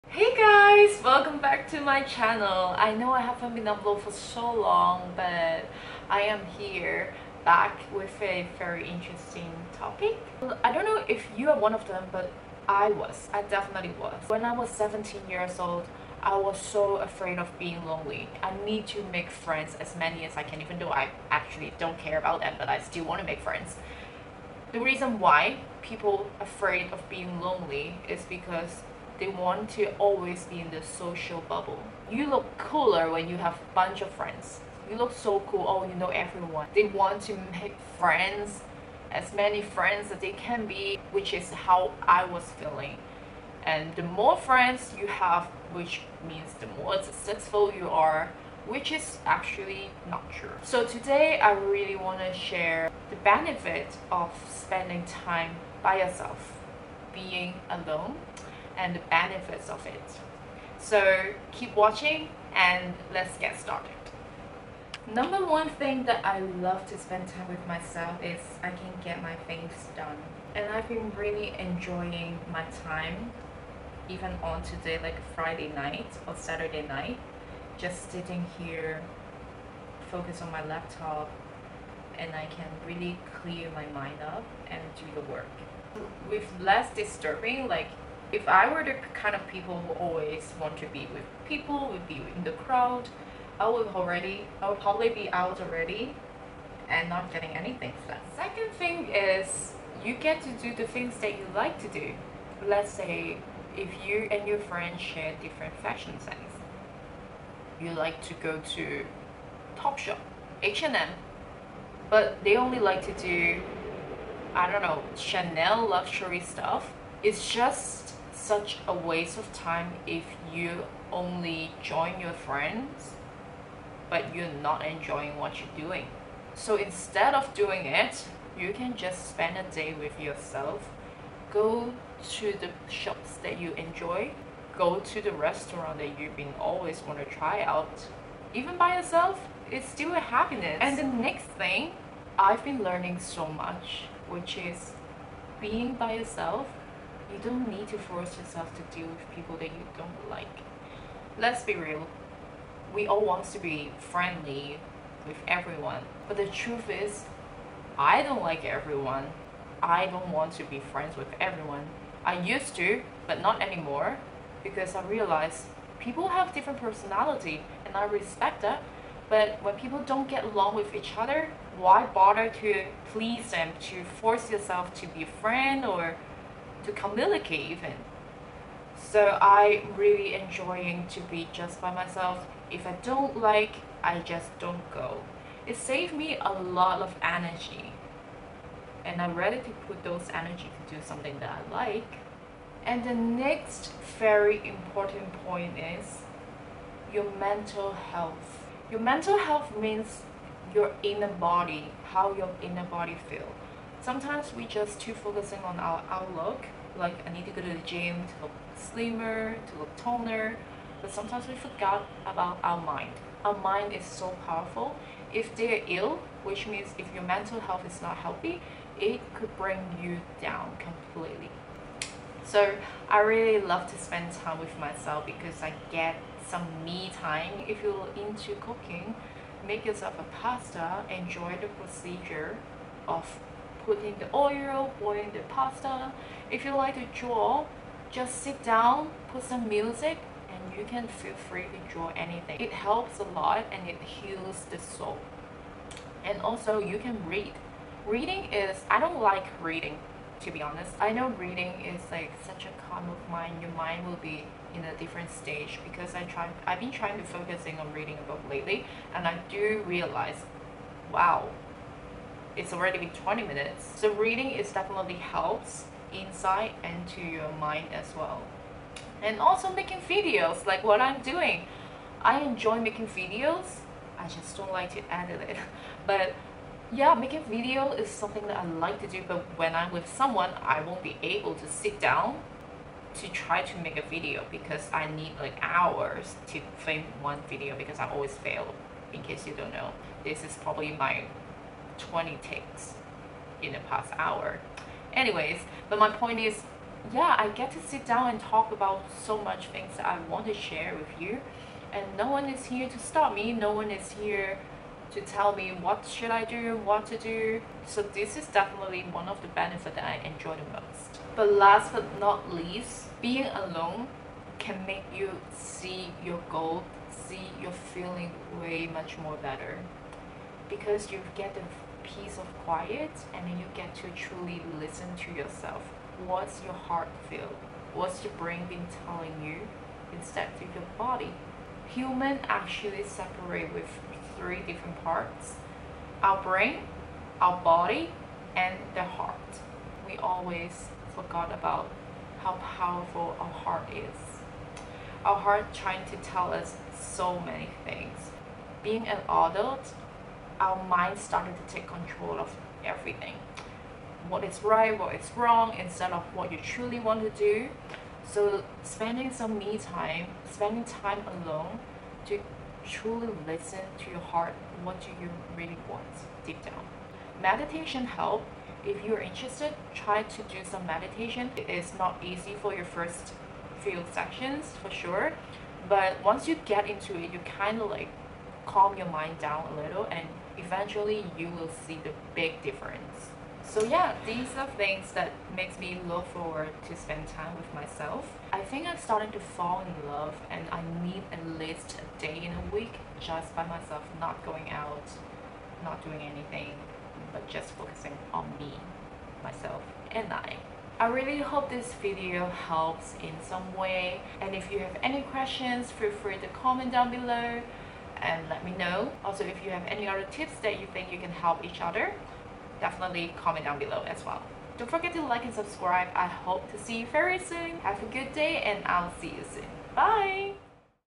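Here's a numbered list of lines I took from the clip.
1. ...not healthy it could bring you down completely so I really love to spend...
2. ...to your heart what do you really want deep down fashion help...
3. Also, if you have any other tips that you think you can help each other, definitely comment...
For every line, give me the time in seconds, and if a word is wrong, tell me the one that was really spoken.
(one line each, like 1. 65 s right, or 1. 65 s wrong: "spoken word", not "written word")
1. 218 s right
2. 363 s wrong: "meditation", not "fashion"
3. 409 s right.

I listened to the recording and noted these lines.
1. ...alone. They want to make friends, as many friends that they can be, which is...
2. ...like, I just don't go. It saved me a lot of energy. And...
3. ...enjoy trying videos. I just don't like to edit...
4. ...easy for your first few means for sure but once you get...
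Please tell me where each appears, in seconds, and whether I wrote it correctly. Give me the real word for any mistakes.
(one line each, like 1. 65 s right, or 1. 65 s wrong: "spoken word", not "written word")
1. 36 s wrong: "everyone", not "alone"
2. 183 s right
3. 272 s wrong: "making", not "trying"
4. 372 s wrong: "sessions", not "means".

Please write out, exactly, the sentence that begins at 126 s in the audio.
So instead of doing it, you can just spend a day with yourself.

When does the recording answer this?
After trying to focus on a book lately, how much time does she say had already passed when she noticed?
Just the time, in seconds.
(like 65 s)
263 s.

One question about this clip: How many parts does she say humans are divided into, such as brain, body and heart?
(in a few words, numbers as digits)
3.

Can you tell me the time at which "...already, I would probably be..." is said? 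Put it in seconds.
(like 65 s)
93 s.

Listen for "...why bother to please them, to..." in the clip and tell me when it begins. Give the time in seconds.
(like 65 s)
171 s.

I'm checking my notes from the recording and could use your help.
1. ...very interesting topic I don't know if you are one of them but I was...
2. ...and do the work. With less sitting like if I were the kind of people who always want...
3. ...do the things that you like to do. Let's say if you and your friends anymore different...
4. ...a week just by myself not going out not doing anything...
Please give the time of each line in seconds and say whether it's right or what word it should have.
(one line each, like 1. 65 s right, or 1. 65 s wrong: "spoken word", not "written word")
1. 8 s right
2. 84 s wrong: "disturbing", not "sitting"
3. 100 s wrong: "share", not "anymore"
4. 392 s right.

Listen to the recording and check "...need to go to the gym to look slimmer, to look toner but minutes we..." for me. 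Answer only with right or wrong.
wrong.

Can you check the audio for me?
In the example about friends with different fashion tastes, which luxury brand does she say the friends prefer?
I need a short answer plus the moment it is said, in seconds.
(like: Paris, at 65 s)
Chanel, at 115 s.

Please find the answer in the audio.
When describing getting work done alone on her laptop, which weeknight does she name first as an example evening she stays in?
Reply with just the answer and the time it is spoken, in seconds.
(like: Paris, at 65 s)
Friday, at 75 s.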